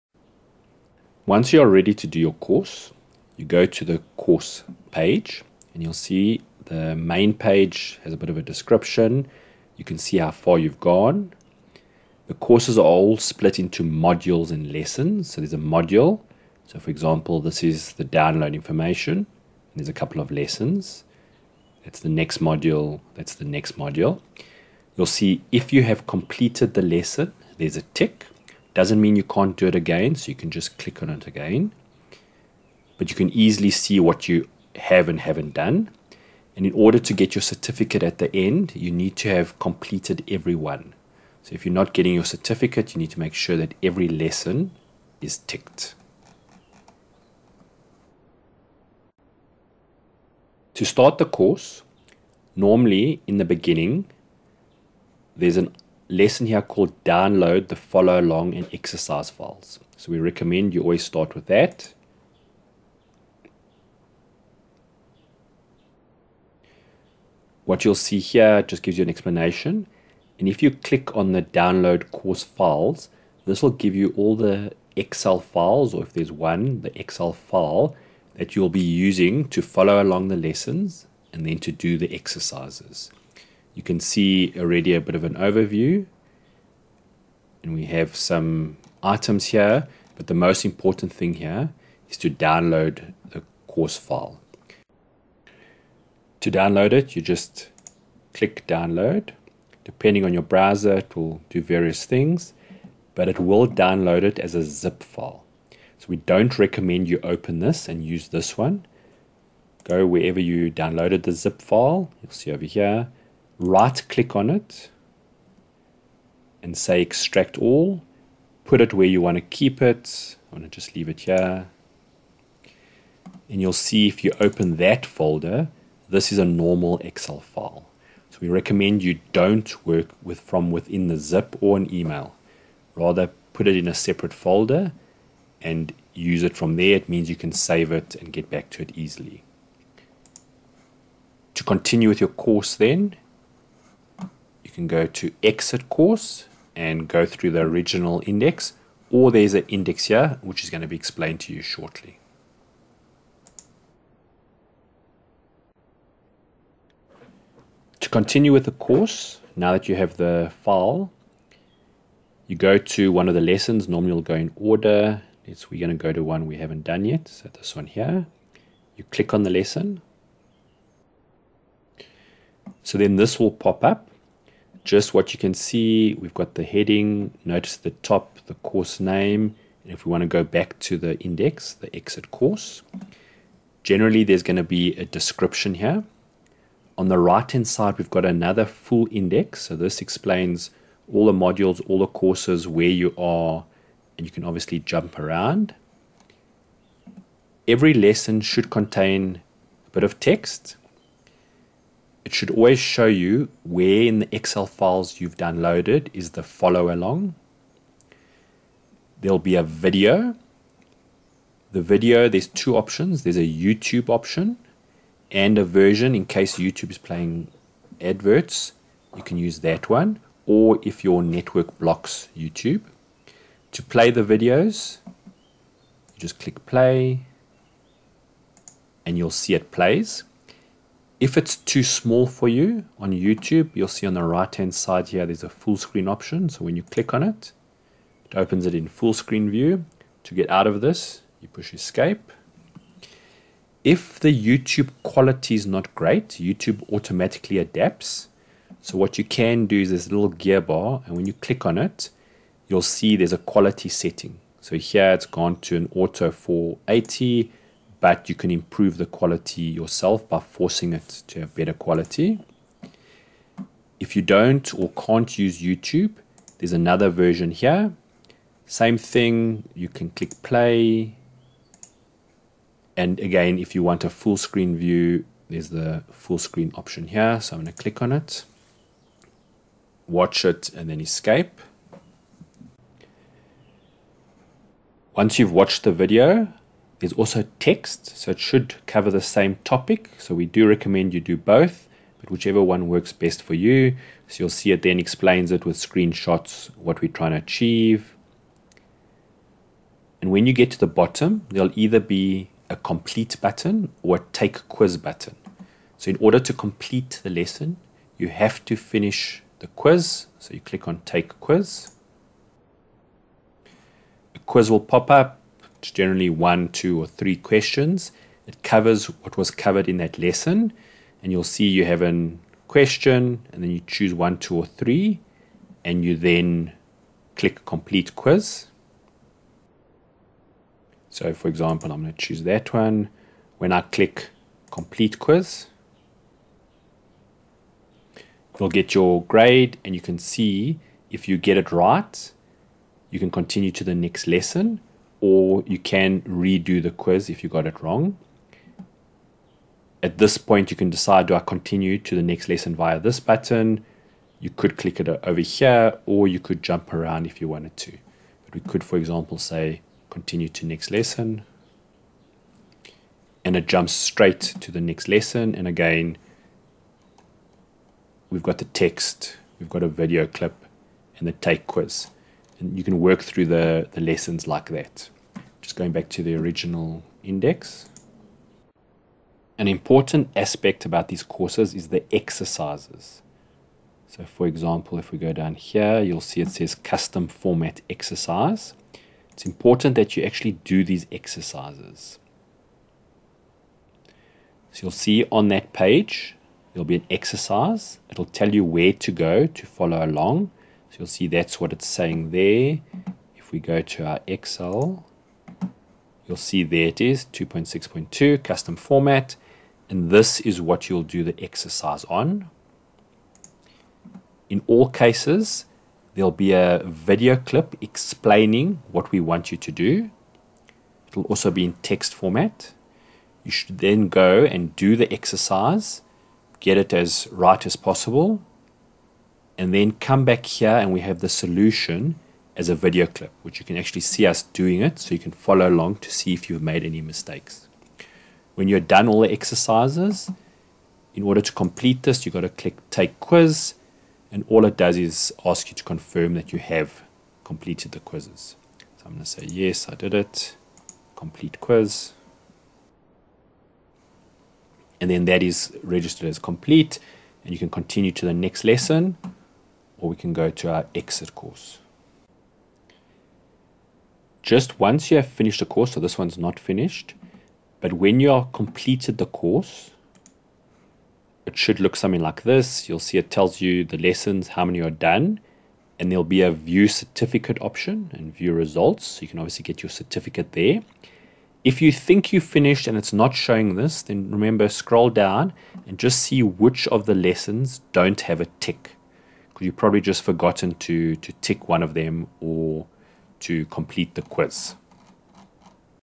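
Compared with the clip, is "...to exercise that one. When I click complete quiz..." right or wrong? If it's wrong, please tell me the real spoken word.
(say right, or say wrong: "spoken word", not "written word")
wrong: "choose", not "exercise".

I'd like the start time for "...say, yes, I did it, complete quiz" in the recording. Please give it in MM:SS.
07:29.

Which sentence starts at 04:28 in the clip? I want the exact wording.
Same thing, you can click play.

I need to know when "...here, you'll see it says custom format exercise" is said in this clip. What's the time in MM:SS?
06:25.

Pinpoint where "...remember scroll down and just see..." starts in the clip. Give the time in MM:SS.
08:04.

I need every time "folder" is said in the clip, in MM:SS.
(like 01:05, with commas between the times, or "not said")
02:05, 02:14.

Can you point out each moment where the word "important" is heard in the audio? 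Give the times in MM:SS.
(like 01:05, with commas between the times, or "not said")
01:30, 06:19, 06:29.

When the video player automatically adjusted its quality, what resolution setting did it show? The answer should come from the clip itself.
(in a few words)
Auto 480.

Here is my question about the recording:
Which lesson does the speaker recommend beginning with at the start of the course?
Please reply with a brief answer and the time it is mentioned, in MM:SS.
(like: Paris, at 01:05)
Download the follow along and exercise files, at 00:57.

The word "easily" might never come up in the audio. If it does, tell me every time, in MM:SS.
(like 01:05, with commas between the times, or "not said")
00:33, 02:18.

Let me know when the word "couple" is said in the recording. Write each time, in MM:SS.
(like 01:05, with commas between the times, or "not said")
00:19.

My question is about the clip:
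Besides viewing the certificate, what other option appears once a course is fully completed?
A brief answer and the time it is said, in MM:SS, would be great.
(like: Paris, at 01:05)
View results, at 07:58.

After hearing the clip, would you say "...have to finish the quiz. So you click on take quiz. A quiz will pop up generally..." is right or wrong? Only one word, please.
right.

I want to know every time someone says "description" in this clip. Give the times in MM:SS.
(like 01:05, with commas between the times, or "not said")
00:08, 03:05.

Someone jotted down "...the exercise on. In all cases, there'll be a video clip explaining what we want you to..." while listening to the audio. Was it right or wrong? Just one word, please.
right.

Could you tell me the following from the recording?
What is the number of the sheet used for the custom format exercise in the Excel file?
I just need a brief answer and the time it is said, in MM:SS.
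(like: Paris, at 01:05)
2.6.2, at 06:47.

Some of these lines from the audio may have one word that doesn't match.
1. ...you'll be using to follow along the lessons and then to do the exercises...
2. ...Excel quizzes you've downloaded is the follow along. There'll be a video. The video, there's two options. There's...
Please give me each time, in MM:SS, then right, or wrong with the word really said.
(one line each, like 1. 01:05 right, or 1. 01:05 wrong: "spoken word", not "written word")
1. 01:18 right
2. 03:24 wrong: "files", not "quizzes".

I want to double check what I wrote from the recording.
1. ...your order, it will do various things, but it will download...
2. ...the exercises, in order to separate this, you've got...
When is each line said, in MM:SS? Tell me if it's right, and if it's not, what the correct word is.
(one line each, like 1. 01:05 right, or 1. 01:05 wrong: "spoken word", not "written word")
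1. 01:40 wrong: "browser", not "order"
2. 07:19 wrong: "complete", not "separate".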